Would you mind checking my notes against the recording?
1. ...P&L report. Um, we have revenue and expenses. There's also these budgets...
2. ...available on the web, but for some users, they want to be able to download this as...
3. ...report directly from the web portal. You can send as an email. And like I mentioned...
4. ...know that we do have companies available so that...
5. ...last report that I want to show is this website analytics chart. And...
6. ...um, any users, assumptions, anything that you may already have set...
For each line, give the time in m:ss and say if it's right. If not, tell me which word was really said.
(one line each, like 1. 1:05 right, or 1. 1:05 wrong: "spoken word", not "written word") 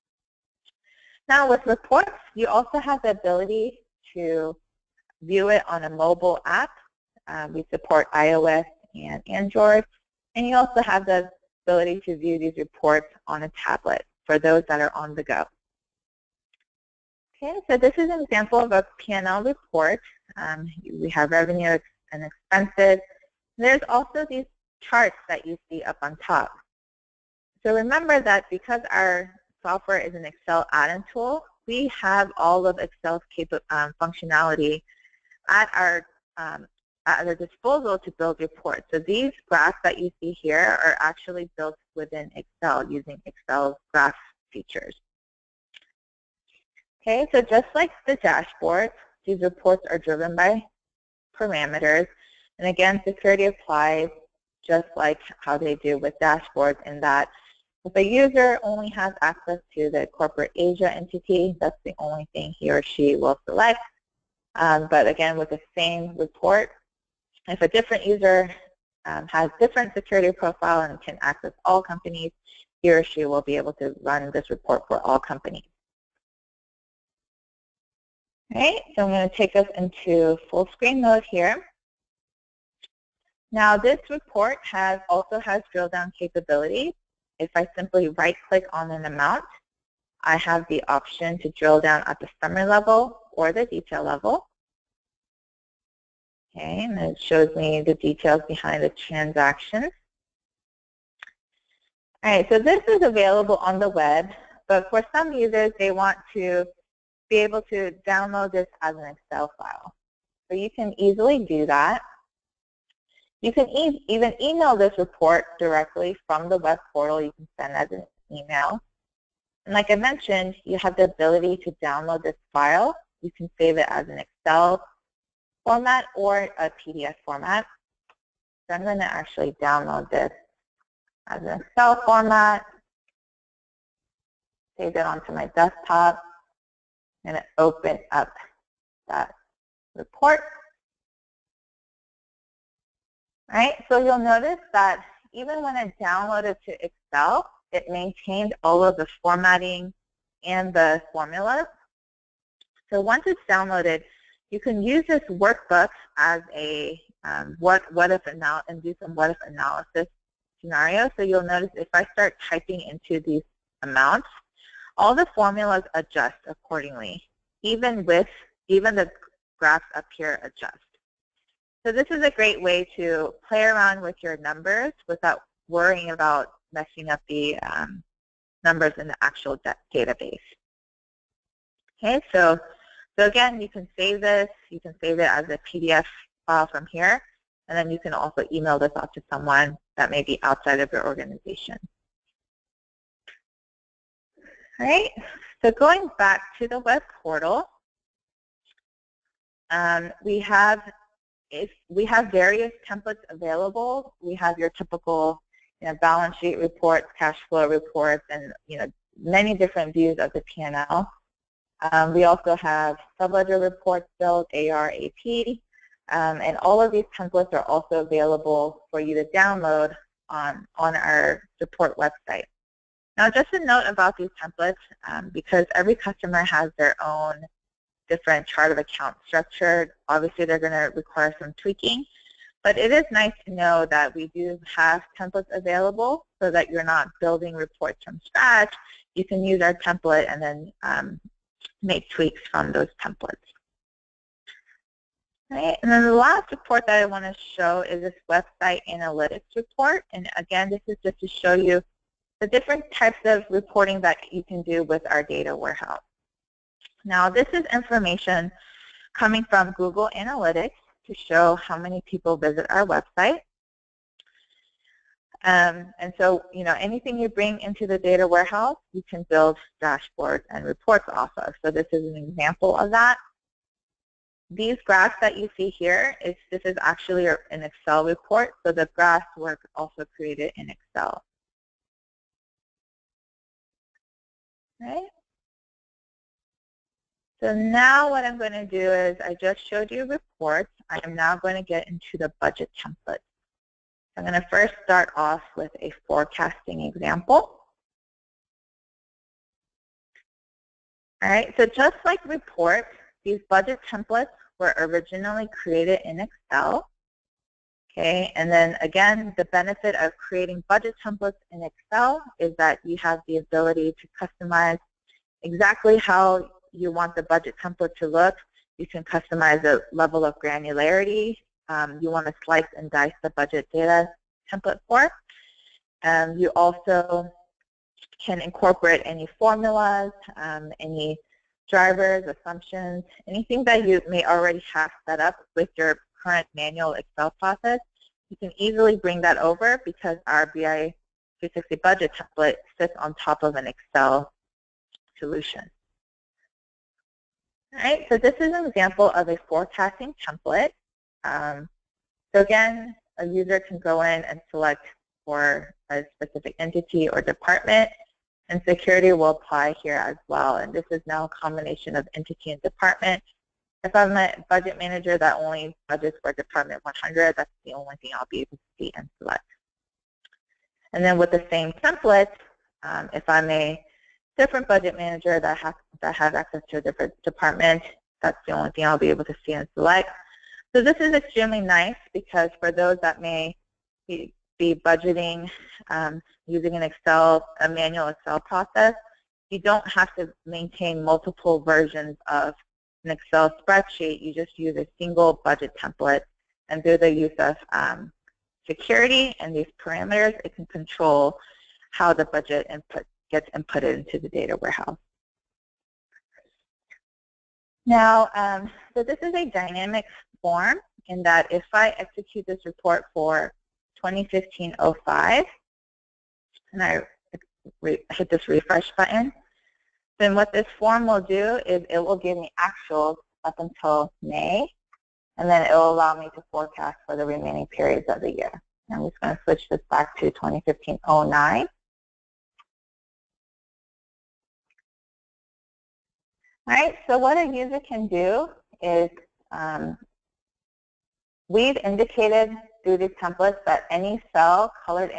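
1. 0:18 wrong: "charts", not "budgets"
2. 1:43 right
3. 1:54 right
4. 3:53 wrong: "templates", not "companies"
5. 4:06 wrong: "report", not "chart"
6. 5:30 wrong: "drivers", not "users".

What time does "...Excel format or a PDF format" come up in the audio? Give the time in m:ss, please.
2:04.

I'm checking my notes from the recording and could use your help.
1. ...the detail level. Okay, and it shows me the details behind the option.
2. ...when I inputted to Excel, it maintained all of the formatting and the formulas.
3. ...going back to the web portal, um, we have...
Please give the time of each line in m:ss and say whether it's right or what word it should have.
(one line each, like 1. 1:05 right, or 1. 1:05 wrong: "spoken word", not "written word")
1. 1:33 wrong: "transaction", not "option"
2. 2:25 wrong: "downloaded", not "inputted"
3. 3:15 right.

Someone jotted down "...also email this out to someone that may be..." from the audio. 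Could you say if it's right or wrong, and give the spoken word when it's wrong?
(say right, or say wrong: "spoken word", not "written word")
right.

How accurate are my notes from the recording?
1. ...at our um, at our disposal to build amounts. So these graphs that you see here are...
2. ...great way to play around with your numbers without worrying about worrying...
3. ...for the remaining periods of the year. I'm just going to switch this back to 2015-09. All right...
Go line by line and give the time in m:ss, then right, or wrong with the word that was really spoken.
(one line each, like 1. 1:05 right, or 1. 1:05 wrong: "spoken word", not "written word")
1. 0:35 wrong: "reports", not "amounts"
2. 2:52 wrong: "messing", not "worrying"
3. 7:07 right.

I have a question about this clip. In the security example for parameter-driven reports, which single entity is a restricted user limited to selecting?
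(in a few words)
Corporate Asia.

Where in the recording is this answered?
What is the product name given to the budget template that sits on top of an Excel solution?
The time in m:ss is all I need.
5:40.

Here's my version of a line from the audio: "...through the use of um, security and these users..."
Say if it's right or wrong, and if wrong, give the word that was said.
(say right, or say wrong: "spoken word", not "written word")
wrong: "parameters", not "users".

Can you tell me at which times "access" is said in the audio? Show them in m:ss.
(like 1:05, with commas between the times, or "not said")
0:59, 1:11, 6:16.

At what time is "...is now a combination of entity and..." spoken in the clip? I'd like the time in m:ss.
6:00.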